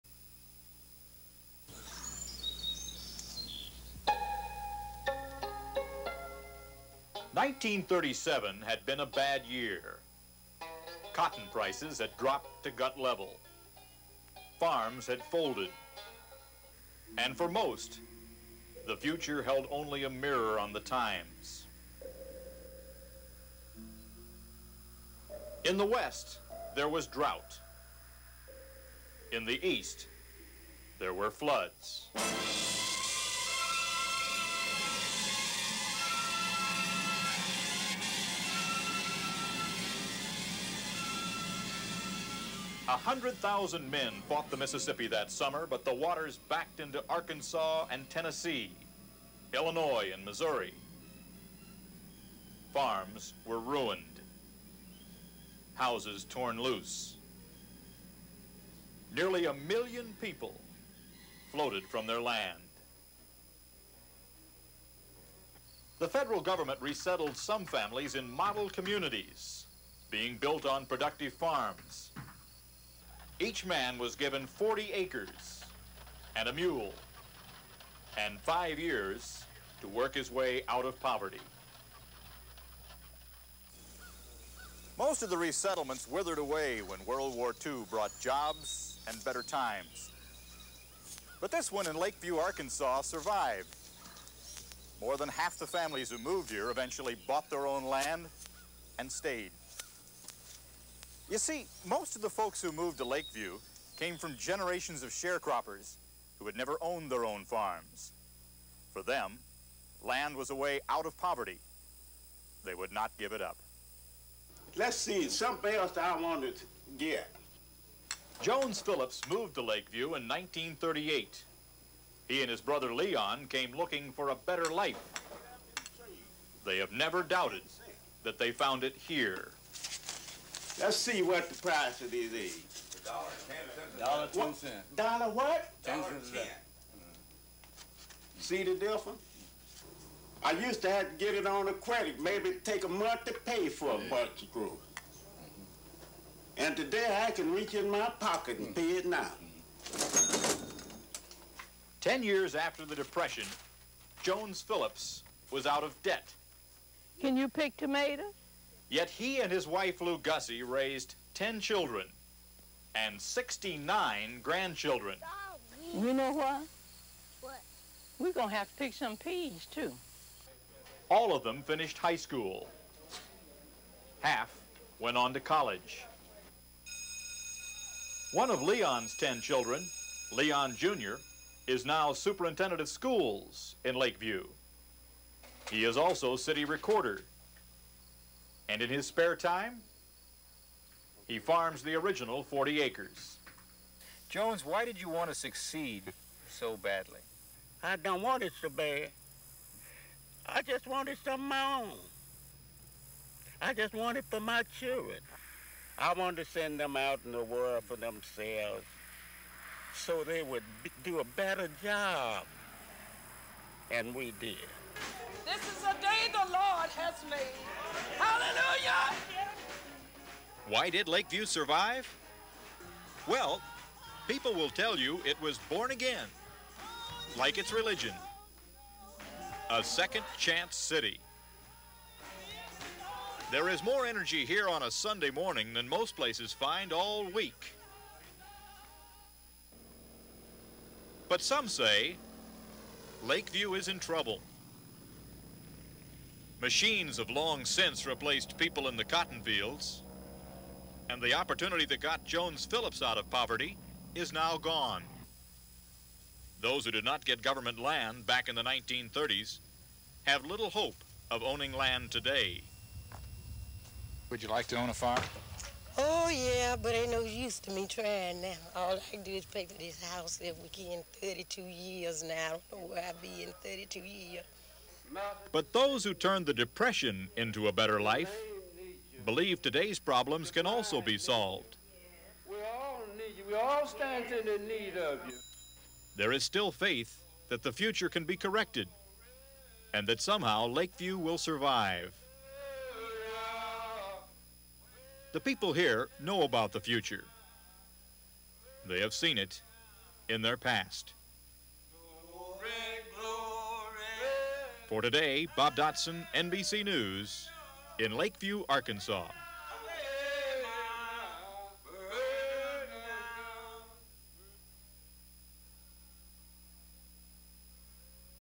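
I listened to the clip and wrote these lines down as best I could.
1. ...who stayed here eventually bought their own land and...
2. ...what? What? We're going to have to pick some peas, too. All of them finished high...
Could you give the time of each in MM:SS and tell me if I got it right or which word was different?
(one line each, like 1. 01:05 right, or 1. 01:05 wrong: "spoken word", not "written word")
1. 01:36 wrong: "moved", not "stayed"
2. 02:46 right.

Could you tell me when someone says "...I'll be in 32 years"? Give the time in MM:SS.
04:33.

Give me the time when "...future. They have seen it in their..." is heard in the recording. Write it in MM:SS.
04:56.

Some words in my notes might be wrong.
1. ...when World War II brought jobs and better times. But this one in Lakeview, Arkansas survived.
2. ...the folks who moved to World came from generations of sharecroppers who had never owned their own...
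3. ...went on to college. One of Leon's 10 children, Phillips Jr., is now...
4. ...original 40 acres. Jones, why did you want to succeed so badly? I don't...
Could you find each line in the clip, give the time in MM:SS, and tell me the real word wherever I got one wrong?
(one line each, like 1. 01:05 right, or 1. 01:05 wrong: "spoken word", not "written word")
1. 01:26 right
2. 01:42 wrong: "Lakeview", not "World"
3. 02:54 wrong: "Leon", not "Phillips"
4. 03:11 right.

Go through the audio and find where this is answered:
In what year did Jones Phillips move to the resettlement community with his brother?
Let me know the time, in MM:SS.
02:00.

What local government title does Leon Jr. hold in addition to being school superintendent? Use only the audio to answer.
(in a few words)
city recorder.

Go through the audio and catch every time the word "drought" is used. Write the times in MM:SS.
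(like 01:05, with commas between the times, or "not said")
00:27.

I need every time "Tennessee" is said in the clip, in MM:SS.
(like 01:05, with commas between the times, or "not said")
00:48.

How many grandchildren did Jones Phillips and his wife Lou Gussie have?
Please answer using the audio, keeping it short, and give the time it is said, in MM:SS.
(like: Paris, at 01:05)
69, at 02:43.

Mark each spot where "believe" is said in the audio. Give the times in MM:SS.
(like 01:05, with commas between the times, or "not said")
04:39.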